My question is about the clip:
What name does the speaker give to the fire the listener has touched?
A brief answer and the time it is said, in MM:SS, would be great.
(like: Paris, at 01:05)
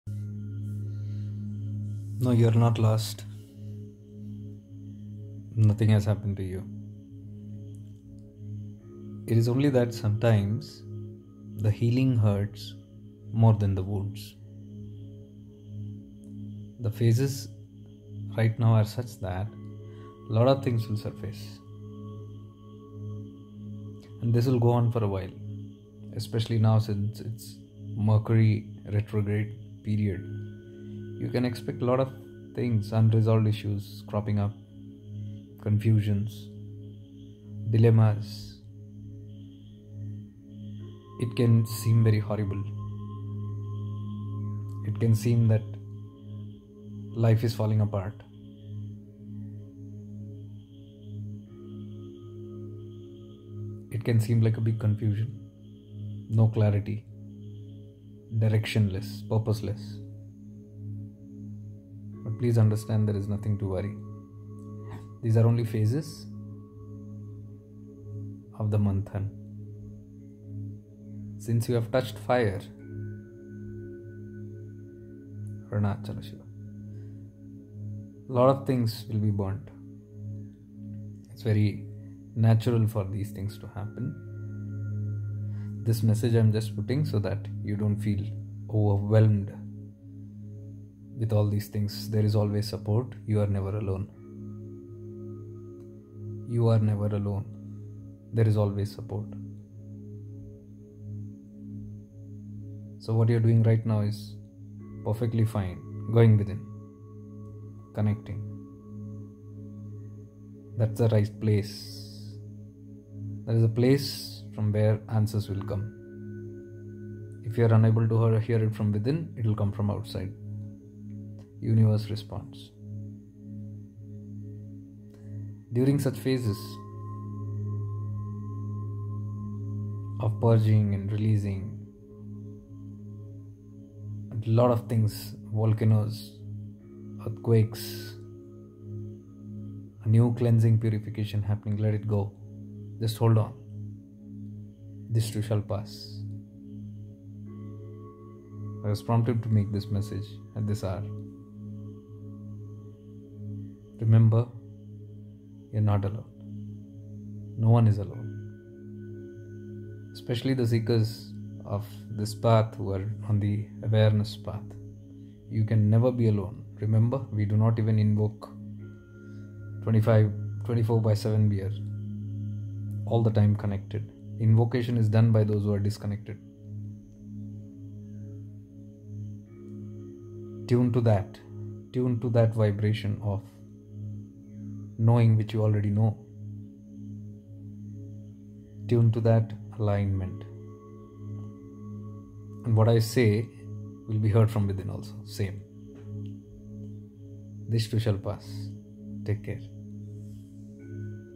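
Arunachala Shiva, at 01:15.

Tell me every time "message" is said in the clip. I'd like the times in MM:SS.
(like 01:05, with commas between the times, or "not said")
01:26, 02:29.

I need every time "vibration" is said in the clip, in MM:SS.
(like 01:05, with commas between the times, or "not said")
03:02.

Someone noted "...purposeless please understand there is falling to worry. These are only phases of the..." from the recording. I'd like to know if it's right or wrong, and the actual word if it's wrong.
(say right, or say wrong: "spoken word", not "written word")
wrong: "nothing", not "falling".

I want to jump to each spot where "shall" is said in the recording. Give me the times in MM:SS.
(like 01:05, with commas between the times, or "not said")
02:25, 03:17.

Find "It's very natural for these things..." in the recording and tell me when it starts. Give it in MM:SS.
01:21.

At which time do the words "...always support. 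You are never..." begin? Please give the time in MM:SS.
01:32.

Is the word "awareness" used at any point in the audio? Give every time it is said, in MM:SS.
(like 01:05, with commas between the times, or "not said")
02:43.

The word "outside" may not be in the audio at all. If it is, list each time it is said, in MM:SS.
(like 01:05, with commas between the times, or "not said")
01:59.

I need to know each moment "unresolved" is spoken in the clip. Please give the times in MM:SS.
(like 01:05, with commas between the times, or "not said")
00:32.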